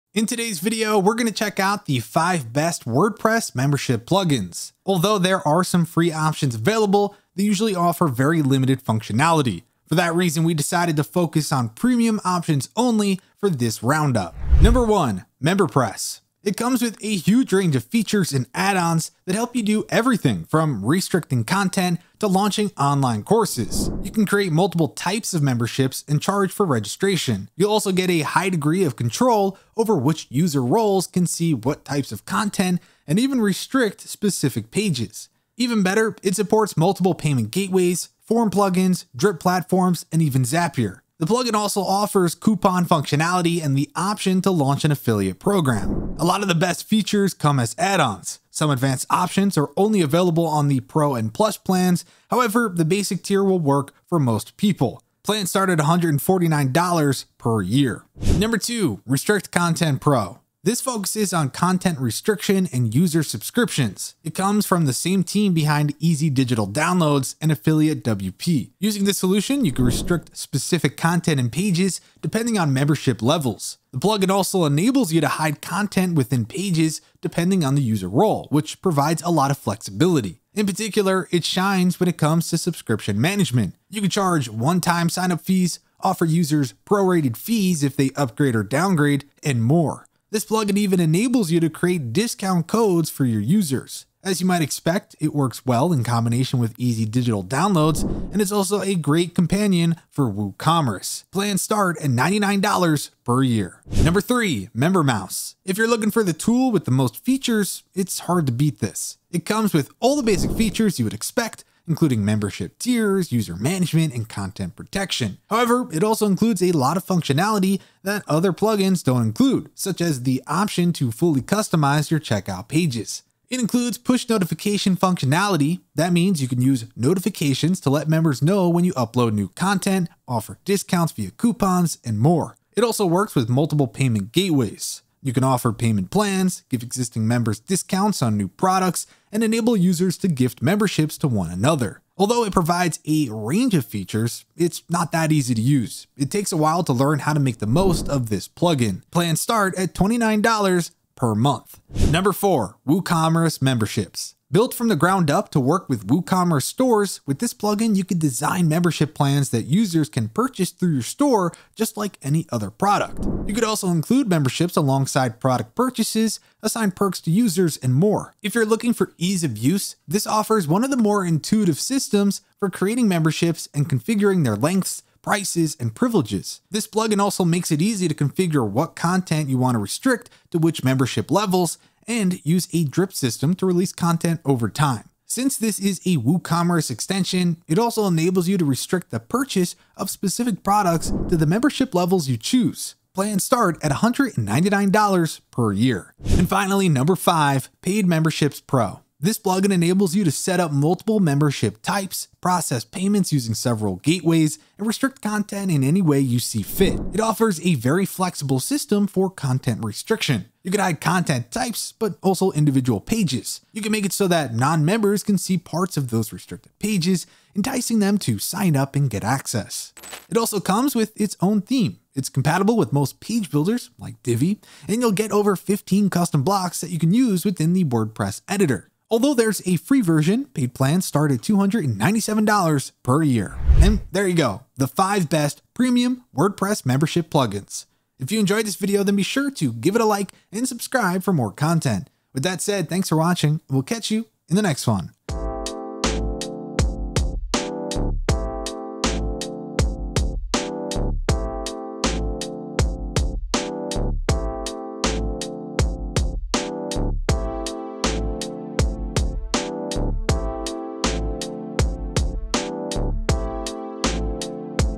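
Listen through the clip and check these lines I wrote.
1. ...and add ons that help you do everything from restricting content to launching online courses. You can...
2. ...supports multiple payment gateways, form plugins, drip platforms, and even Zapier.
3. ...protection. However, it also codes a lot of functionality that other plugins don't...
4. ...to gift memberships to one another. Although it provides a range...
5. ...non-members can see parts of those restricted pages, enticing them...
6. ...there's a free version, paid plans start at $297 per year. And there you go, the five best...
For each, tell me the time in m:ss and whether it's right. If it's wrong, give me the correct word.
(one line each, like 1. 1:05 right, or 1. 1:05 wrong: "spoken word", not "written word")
1. 0:18 right
2. 0:36 right
3. 1:54 wrong: "includes", not "codes"
4. 2:20 right
5. 3:34 right
6. 3:49 right.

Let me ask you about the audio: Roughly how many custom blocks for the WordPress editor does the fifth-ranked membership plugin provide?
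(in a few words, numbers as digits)
over 15.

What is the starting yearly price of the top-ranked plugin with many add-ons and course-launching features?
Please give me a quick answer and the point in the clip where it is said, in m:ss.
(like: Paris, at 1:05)
$149 per year, at 0:55.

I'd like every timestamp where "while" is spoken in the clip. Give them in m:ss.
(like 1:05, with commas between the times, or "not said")
2:26.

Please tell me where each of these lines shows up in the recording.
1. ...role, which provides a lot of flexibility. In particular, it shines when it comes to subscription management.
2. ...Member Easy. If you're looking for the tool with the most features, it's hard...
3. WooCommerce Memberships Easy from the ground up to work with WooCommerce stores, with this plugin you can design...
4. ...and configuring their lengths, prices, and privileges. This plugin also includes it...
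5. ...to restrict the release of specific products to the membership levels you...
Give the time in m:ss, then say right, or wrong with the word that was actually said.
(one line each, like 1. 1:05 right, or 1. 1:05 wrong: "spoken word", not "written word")
1. 1:18 right
2. 1:44 wrong: "Mouse", not "Easy"
3. 2:32 wrong: "Built", not "Easy"
4. 2:53 wrong: "makes", not "includes"
5. 3:08 wrong: "purchase", not "release".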